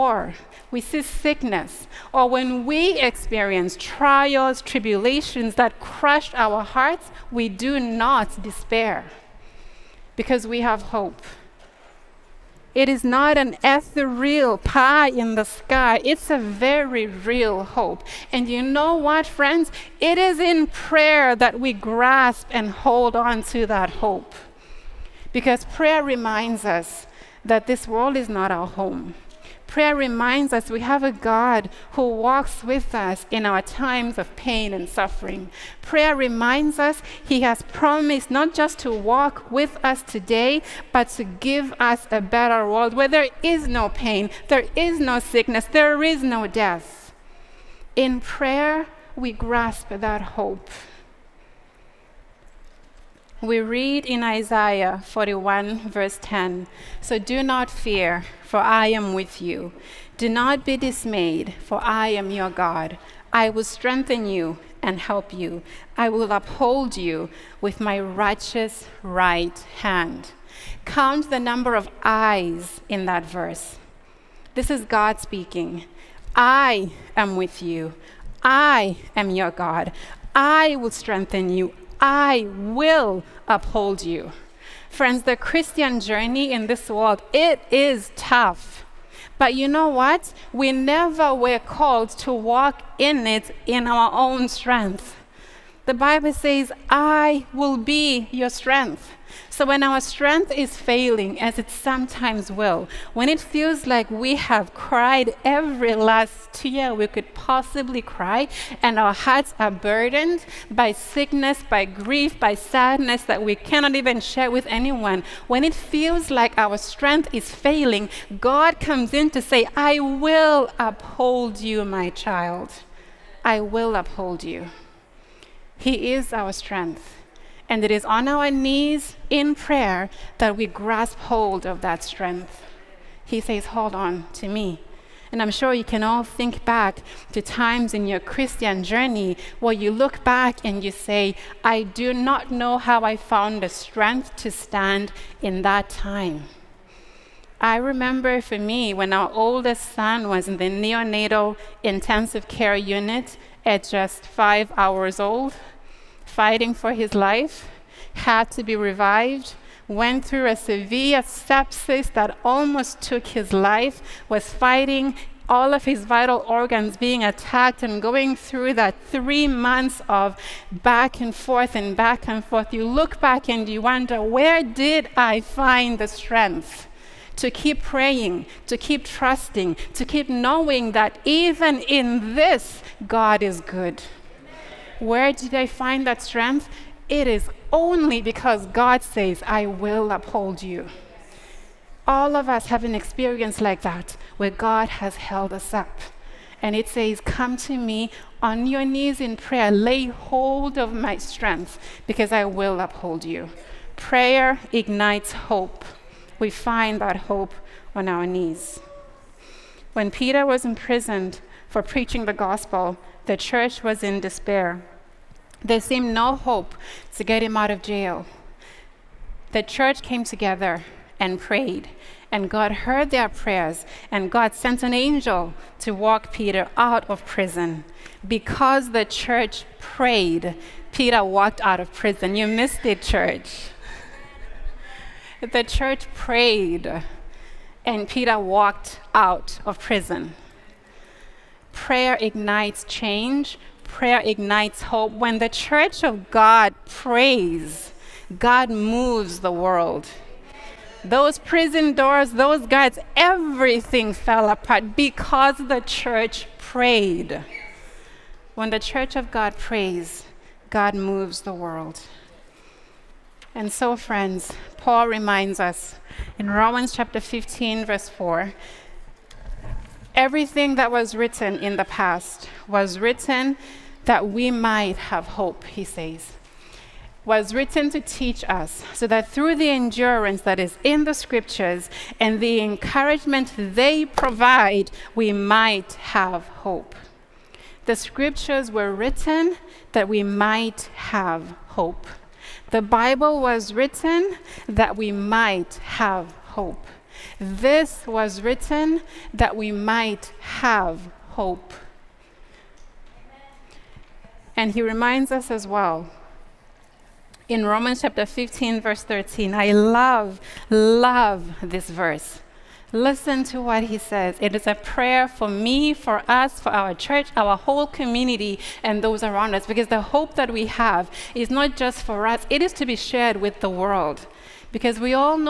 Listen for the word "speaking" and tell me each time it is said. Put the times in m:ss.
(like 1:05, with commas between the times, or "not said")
1:15.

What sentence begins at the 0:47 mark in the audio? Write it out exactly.
In prayer, we grasp that hope.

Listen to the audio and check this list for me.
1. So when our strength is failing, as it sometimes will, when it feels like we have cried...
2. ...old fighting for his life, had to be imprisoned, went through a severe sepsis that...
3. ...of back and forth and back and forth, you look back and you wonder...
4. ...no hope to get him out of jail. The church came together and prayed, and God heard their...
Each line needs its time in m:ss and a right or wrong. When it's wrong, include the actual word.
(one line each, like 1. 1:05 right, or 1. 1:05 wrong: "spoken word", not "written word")
1. 1:39 right
2. 2:35 wrong: "revived", not "imprisoned"
3. 2:50 right
4. 3:36 right.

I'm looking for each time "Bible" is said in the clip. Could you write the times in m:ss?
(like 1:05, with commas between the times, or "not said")
1:35, 4:52.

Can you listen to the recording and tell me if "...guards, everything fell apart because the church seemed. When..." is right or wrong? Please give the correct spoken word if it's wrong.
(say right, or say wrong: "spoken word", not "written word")
wrong: "prayed", not "seemed".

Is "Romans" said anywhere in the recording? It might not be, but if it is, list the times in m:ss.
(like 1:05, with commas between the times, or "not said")
4:26, 5:07.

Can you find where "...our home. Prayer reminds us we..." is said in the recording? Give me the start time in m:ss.
0:28.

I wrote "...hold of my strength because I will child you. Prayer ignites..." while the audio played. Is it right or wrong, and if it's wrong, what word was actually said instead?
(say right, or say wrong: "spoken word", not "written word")
wrong: "uphold", not "child".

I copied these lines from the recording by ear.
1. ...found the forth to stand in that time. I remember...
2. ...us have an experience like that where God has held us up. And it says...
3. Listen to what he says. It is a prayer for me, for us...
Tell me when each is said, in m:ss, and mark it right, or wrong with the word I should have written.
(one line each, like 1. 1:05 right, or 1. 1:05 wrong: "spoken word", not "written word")
1. 2:23 wrong: "strength", not "forth"
2. 3:12 right
3. 5:12 right.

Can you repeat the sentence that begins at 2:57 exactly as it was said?
To keep praying, to keep trusting, to keep knowing that even in this, God is good.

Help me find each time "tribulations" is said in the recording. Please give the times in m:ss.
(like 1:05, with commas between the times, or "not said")
0:04.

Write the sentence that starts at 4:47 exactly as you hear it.
The scriptures were written that we might have hope.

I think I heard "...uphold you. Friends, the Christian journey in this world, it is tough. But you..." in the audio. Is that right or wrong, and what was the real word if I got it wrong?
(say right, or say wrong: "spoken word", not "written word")
right.